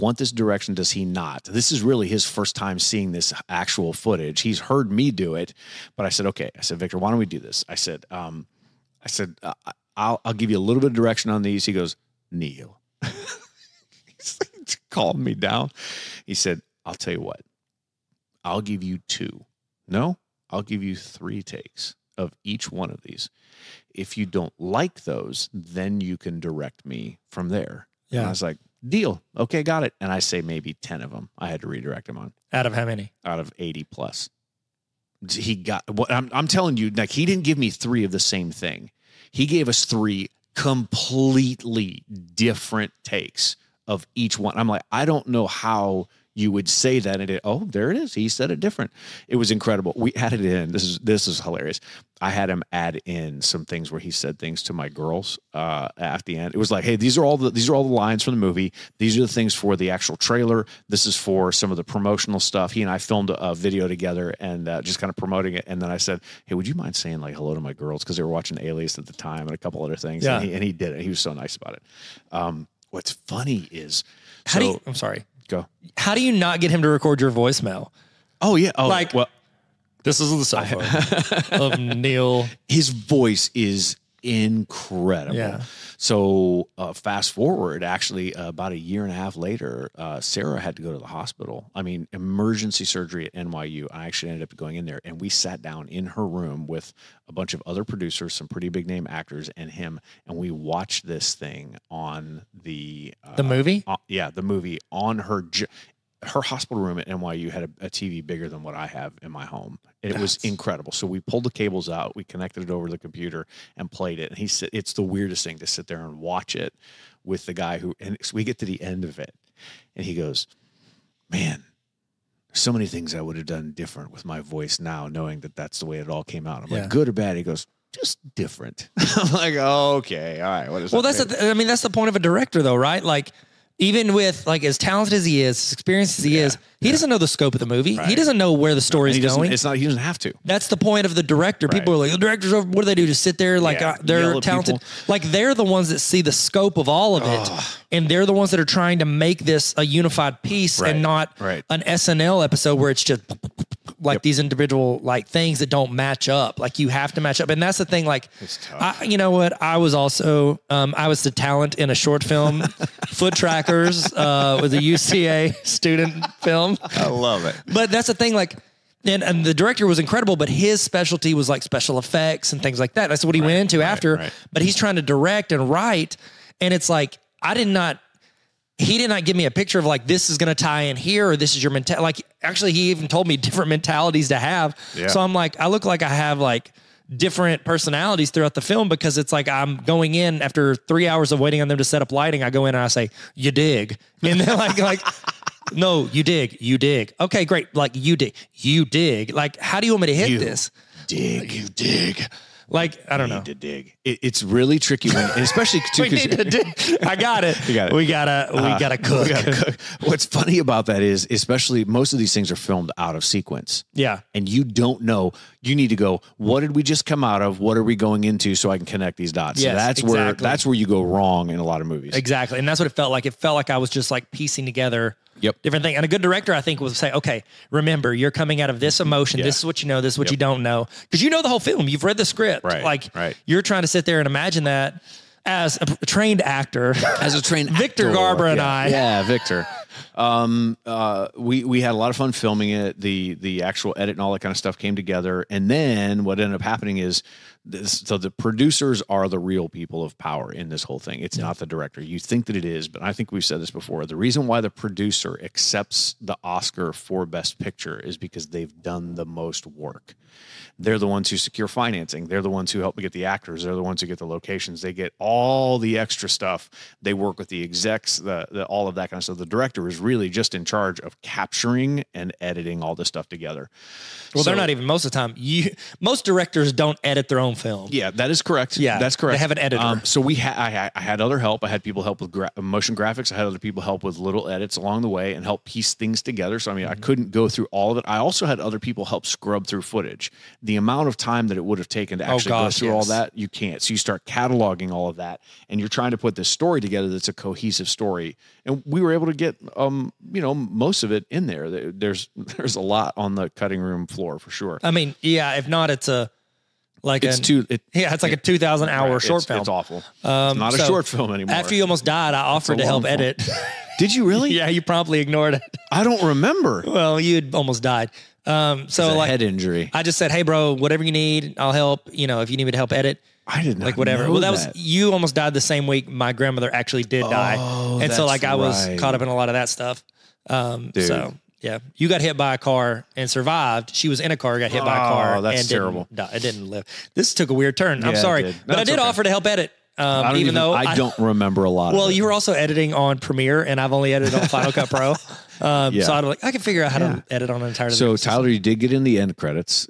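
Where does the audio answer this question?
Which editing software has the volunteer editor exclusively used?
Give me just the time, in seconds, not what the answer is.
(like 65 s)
344 s.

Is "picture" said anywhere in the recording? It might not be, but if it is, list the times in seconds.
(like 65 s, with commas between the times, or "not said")
179 s, 257 s.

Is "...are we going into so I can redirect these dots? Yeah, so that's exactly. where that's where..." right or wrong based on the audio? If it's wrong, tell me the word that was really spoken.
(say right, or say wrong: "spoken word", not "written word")
wrong: "connect", not "redirect".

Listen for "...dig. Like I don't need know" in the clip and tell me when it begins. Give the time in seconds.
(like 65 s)
201 s.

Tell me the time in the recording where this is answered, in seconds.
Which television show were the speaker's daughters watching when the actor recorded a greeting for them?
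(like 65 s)
68 s.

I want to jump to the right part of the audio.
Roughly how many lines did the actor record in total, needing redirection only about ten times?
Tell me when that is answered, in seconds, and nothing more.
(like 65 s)
33 s.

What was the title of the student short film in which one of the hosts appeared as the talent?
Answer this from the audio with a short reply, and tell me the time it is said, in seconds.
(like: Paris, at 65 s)
Foot Trackers, at 163 s.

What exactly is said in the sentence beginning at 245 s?
And then what ended up happening is this, so the producers are the real people of power in this whole thing.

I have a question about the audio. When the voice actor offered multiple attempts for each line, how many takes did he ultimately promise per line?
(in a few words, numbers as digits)
3.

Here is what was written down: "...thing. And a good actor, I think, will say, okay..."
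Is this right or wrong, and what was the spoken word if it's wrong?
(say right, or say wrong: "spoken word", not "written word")
wrong: "director", not "actor".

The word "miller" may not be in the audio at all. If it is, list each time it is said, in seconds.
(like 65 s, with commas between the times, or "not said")
not said.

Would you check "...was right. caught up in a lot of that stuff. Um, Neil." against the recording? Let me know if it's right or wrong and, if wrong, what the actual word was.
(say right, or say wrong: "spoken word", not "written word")
wrong: "Dude", not "Neil".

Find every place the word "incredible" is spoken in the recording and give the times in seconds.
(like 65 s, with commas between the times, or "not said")
49 s, 84 s, 110 s, 169 s.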